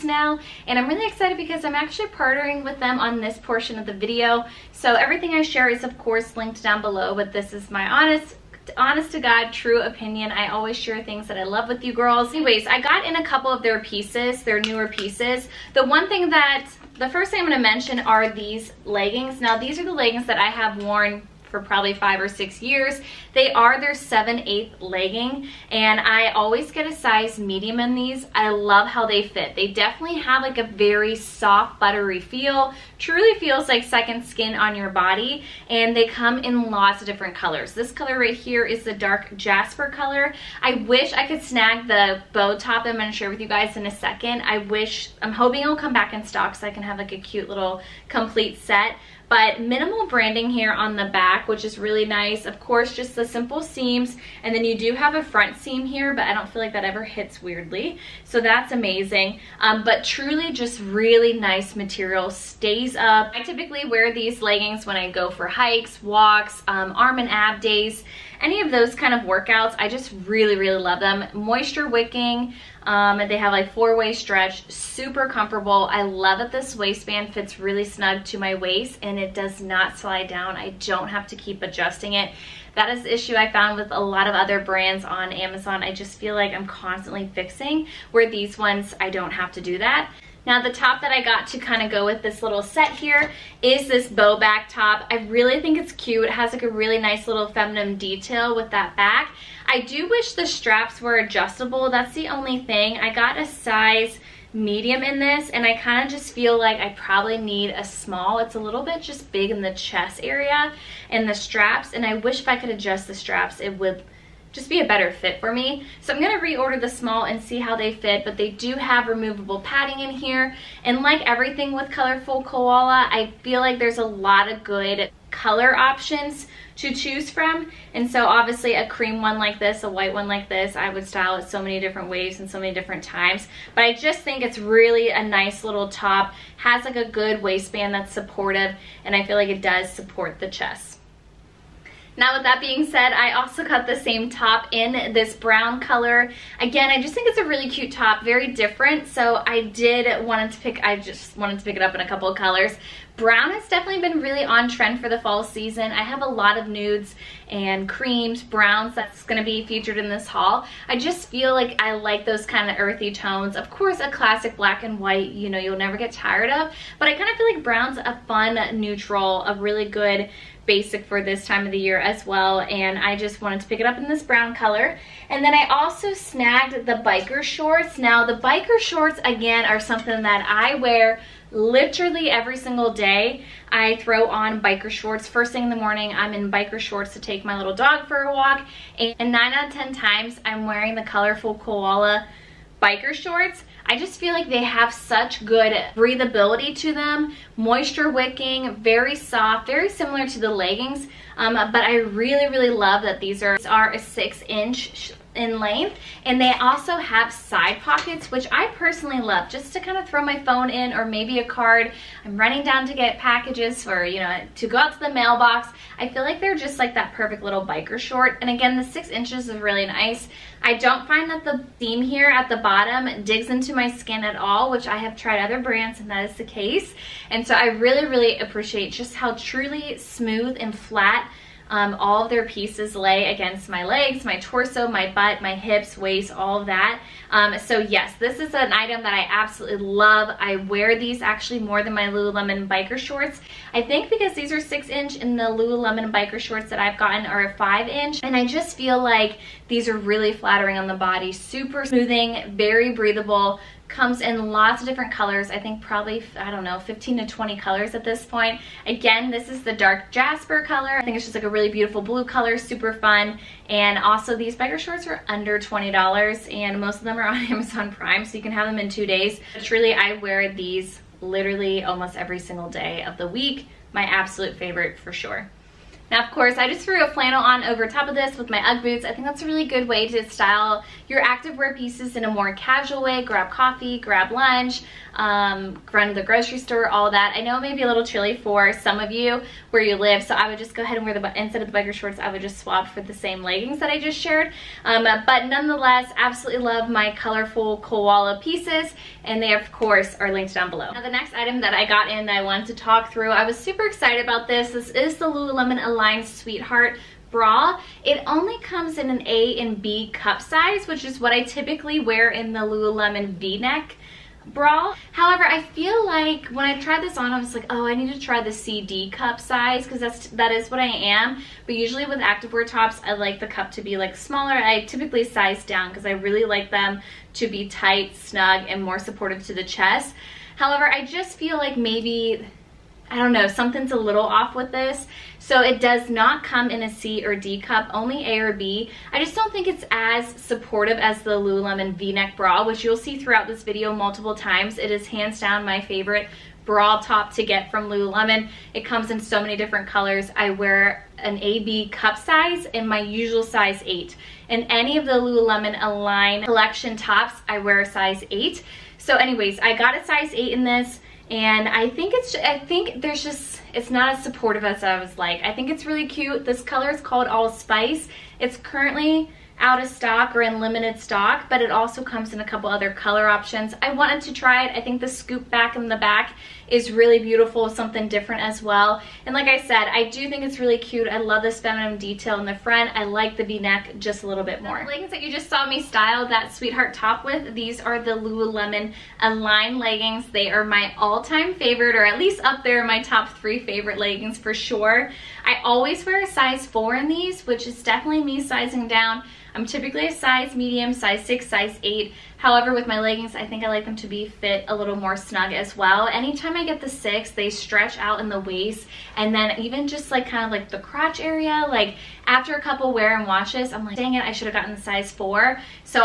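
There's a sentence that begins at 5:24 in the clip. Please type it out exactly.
I typically size down because I really like them to be tight, snug, and more supportive to the chest.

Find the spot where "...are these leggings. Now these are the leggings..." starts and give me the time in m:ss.
0:17.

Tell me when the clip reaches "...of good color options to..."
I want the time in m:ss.
2:04.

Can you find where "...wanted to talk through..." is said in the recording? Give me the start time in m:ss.
5:02.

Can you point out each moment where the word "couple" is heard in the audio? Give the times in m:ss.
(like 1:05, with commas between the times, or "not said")
0:13, 2:32, 6:12, 6:52.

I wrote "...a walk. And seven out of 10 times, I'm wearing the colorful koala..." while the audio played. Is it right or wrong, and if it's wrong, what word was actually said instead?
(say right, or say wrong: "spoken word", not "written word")
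wrong: "nine", not "seven".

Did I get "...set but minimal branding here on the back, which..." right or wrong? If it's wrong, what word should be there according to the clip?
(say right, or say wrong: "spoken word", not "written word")
right.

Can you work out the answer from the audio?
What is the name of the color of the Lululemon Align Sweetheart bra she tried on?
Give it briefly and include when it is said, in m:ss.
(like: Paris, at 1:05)
all spice, at 6:07.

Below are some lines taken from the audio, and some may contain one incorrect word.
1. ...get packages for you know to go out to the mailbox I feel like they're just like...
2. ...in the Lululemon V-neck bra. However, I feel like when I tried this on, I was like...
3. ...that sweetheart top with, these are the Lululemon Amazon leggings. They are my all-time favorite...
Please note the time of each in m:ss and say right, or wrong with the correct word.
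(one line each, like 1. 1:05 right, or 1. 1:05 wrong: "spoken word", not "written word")
1. 3:32 right
2. 5:12 right
3. 6:26 wrong: "Align", not "Amazon".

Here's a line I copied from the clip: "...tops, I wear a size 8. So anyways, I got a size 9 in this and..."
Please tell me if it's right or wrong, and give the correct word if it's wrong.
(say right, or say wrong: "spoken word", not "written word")
wrong: "8", not "9".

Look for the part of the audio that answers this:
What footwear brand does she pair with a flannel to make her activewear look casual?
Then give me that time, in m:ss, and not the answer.
4:38.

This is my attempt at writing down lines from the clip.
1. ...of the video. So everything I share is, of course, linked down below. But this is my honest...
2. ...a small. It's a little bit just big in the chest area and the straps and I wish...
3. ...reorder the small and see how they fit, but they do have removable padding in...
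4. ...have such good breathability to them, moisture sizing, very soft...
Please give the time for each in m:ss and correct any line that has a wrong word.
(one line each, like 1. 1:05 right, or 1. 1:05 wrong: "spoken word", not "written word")
1. 0:03 right
2. 1:47 right
3. 1:56 right
4. 3:14 wrong: "wicking", not "sizing".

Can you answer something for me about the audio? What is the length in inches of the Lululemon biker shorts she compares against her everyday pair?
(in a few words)
5 inch.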